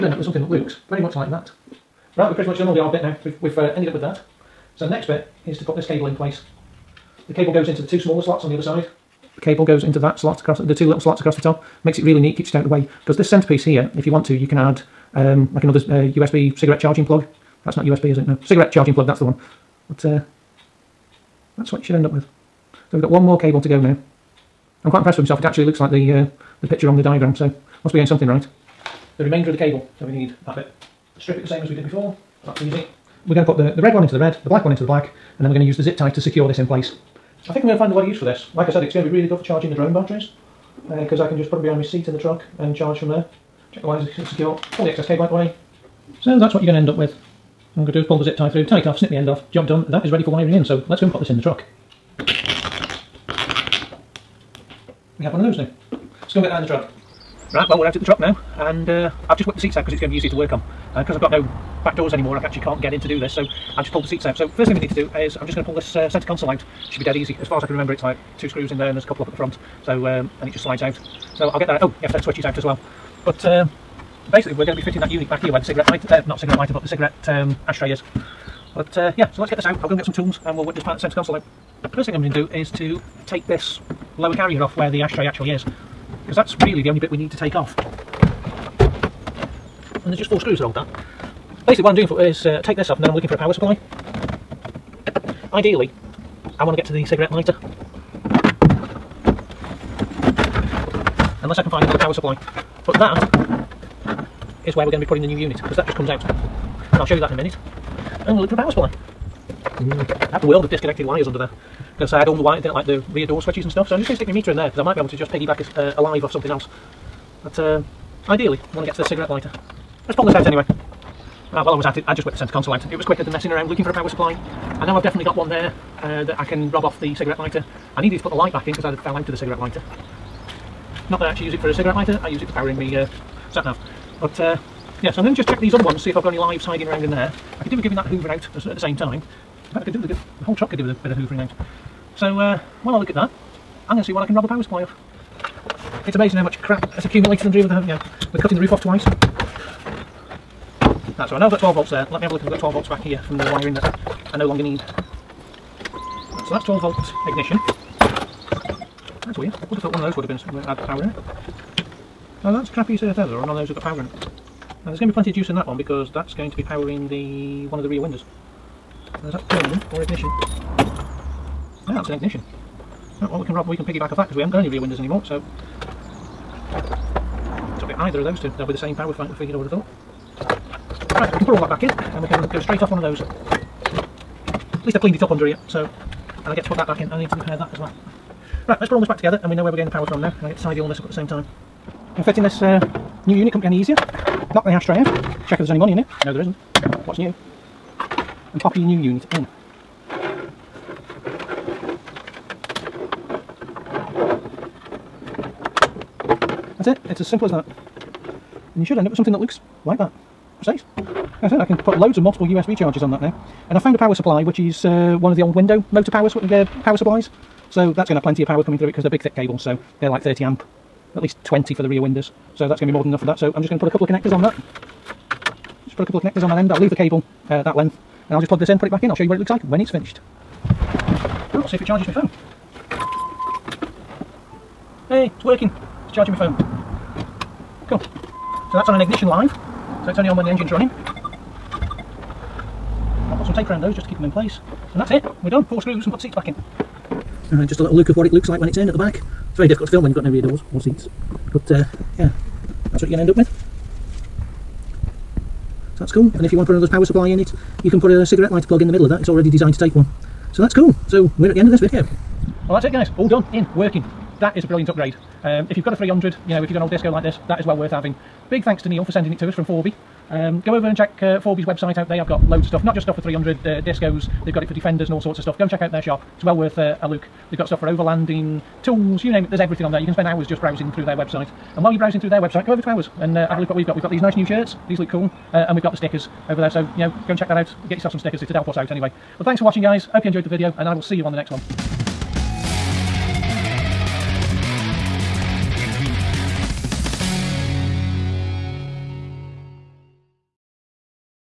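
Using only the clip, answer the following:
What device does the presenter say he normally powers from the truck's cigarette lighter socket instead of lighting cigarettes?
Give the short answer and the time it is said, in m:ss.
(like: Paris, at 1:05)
sat nav, at 2:13.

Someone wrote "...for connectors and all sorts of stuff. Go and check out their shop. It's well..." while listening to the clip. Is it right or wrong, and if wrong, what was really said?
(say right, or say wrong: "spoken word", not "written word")
wrong: "defenders", not "connectors".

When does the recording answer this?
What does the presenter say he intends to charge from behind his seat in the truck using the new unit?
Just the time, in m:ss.
0:39.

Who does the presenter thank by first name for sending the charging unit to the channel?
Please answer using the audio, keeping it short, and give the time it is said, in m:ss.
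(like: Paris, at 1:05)
Neil, at 4:28.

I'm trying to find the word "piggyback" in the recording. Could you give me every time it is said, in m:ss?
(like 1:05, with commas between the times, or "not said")
1:55, 2:53.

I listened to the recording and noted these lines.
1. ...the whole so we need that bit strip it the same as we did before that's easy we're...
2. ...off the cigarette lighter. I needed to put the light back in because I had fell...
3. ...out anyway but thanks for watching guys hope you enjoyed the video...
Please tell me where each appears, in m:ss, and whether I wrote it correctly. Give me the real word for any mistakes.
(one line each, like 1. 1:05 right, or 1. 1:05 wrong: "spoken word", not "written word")
1. 0:29 wrong: "cable", not "whole"
2. 2:06 right
3. 4:48 right.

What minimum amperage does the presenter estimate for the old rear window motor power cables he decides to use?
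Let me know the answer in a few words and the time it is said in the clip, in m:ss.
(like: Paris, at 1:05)
20, at 3:41.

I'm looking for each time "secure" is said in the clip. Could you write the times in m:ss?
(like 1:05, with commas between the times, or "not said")
0:36, 0:44.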